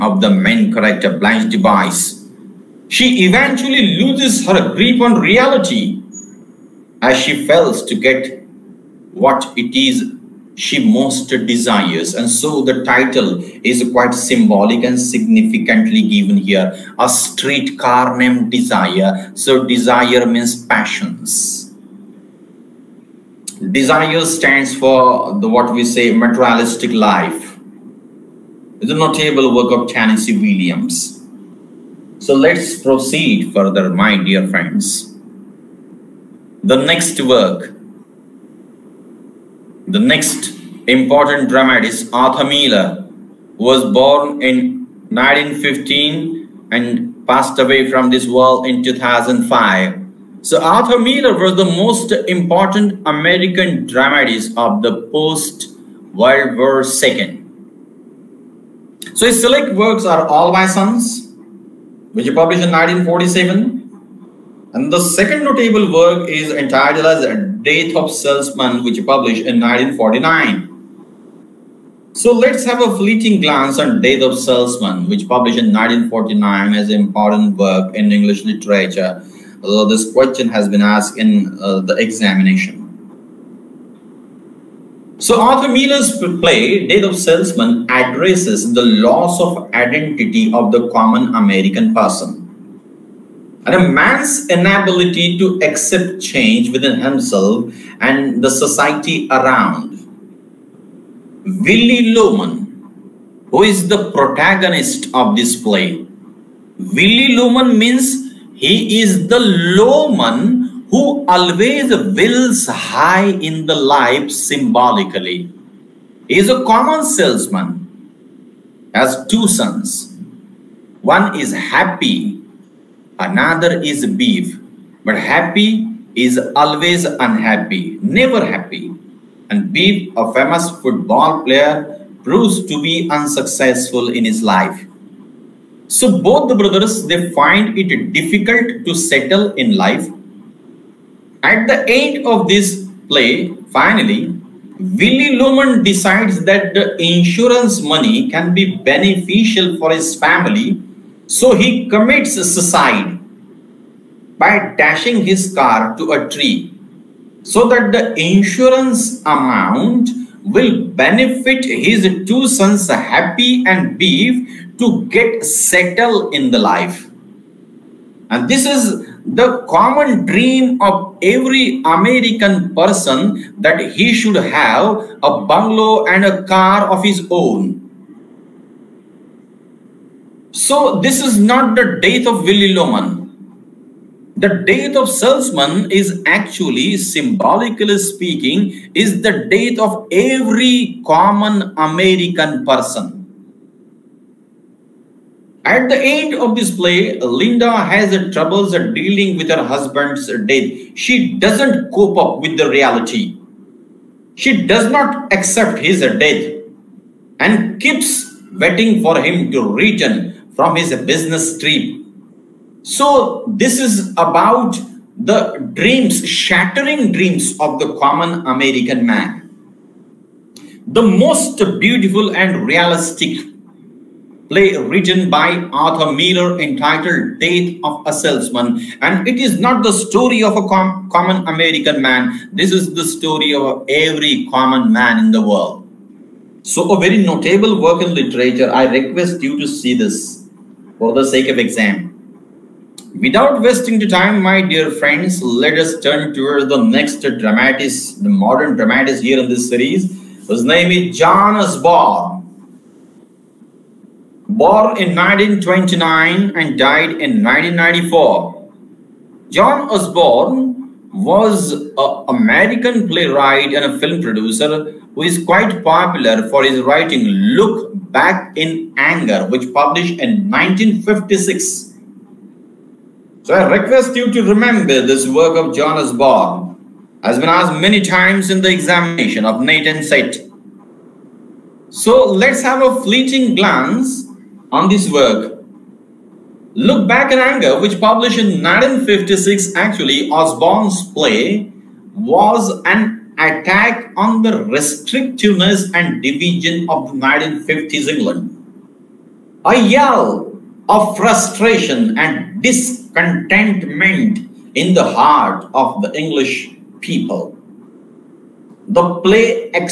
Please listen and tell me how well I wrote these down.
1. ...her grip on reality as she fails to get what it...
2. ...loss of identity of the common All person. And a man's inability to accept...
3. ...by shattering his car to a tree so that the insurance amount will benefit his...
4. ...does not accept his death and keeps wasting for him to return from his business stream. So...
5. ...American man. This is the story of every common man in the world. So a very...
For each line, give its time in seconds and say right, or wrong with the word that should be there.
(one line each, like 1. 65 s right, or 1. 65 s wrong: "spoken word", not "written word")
1. 4 s right
2. 88 s wrong: "American", not "All"
3. 154 s wrong: "dashing", not "shattering"
4. 204 s wrong: "waiting", not "wasting"
5. 231 s right.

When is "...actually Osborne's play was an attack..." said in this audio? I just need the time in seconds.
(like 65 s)
289 s.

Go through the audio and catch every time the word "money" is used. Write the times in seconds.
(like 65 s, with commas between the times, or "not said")
147 s.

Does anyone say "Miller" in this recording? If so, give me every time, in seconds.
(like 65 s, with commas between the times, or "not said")
42 s, 50 s, 85 s, 226 s.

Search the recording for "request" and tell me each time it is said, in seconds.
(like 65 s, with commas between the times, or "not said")
238 s, 273 s.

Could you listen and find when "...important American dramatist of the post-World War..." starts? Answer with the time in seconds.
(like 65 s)
52 s.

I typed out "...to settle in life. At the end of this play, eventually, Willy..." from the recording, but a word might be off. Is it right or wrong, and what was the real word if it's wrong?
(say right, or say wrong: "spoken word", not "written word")
wrong: "finally", not "eventually".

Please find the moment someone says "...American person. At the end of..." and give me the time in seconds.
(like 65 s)
191 s.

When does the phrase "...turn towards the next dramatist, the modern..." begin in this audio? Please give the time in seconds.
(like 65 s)
245 s.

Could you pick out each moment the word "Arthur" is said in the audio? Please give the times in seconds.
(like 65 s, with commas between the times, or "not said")
42 s, 50 s, 85 s, 225 s.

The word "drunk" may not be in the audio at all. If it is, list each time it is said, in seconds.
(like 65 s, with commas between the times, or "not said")
not said.